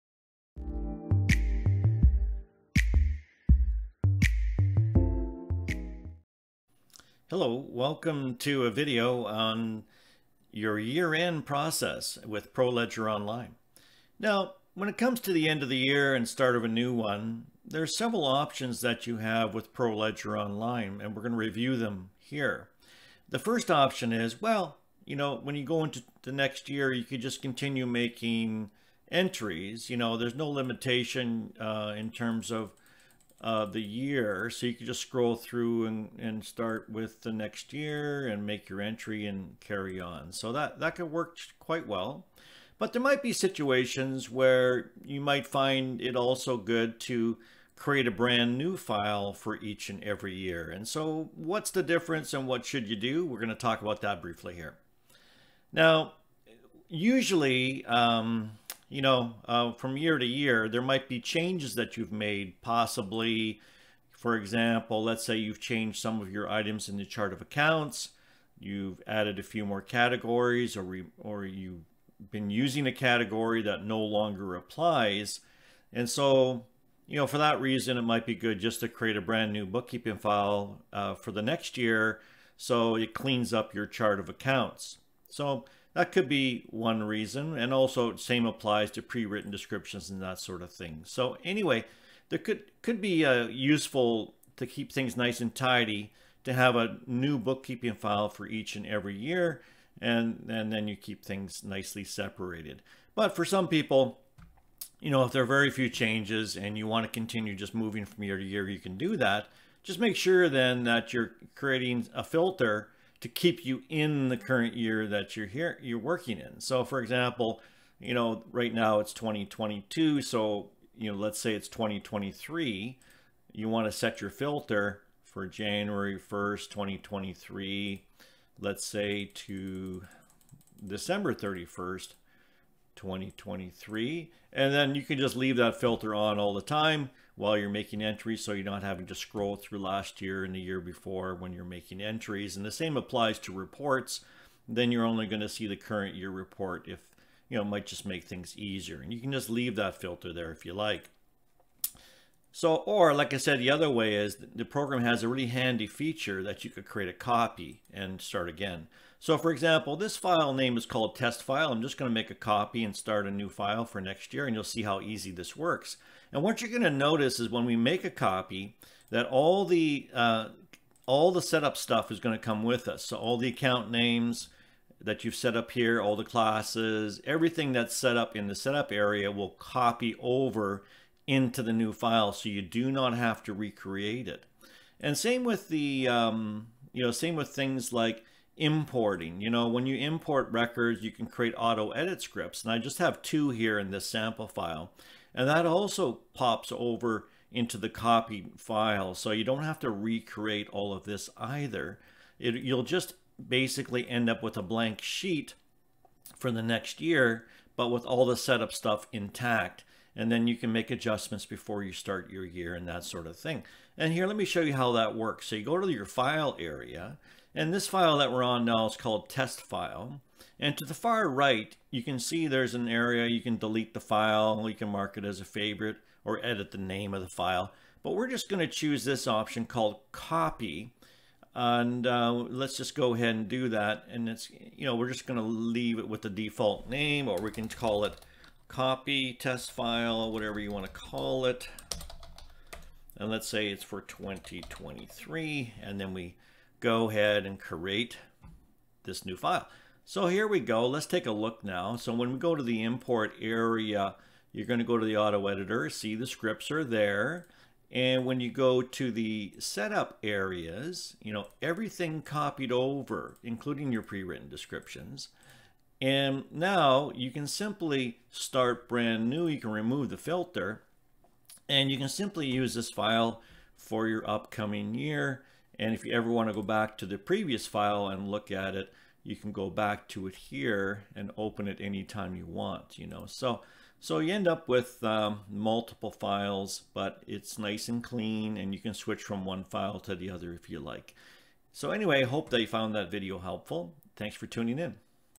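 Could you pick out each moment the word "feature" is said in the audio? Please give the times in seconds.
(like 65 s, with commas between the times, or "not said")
155 s.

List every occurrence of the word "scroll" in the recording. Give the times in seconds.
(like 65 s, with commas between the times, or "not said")
35 s, 139 s.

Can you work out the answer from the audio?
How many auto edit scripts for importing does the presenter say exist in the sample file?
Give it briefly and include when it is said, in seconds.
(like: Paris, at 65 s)
2, at 193 s.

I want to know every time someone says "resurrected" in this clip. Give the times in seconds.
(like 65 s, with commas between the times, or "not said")
not said.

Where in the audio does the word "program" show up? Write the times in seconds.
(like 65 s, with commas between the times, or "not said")
154 s.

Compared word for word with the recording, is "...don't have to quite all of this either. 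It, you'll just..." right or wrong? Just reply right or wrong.
wrong.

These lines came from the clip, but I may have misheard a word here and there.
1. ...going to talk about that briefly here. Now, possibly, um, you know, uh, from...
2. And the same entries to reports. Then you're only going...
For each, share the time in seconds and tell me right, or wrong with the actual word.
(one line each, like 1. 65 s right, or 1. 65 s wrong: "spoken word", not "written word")
1. 53 s wrong: "usually", not "possibly"
2. 142 s wrong: "applies", not "entries".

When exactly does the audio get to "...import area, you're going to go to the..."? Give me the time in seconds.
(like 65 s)
252 s.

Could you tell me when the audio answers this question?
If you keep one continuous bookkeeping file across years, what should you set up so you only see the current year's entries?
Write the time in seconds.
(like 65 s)
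111 s.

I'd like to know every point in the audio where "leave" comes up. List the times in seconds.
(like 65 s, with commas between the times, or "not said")
135 s, 149 s, 235 s.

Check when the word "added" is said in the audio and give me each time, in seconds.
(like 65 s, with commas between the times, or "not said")
69 s.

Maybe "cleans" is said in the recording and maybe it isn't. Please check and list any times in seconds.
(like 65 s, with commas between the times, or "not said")
83 s, 288 s.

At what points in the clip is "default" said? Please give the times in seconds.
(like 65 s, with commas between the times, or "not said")
236 s.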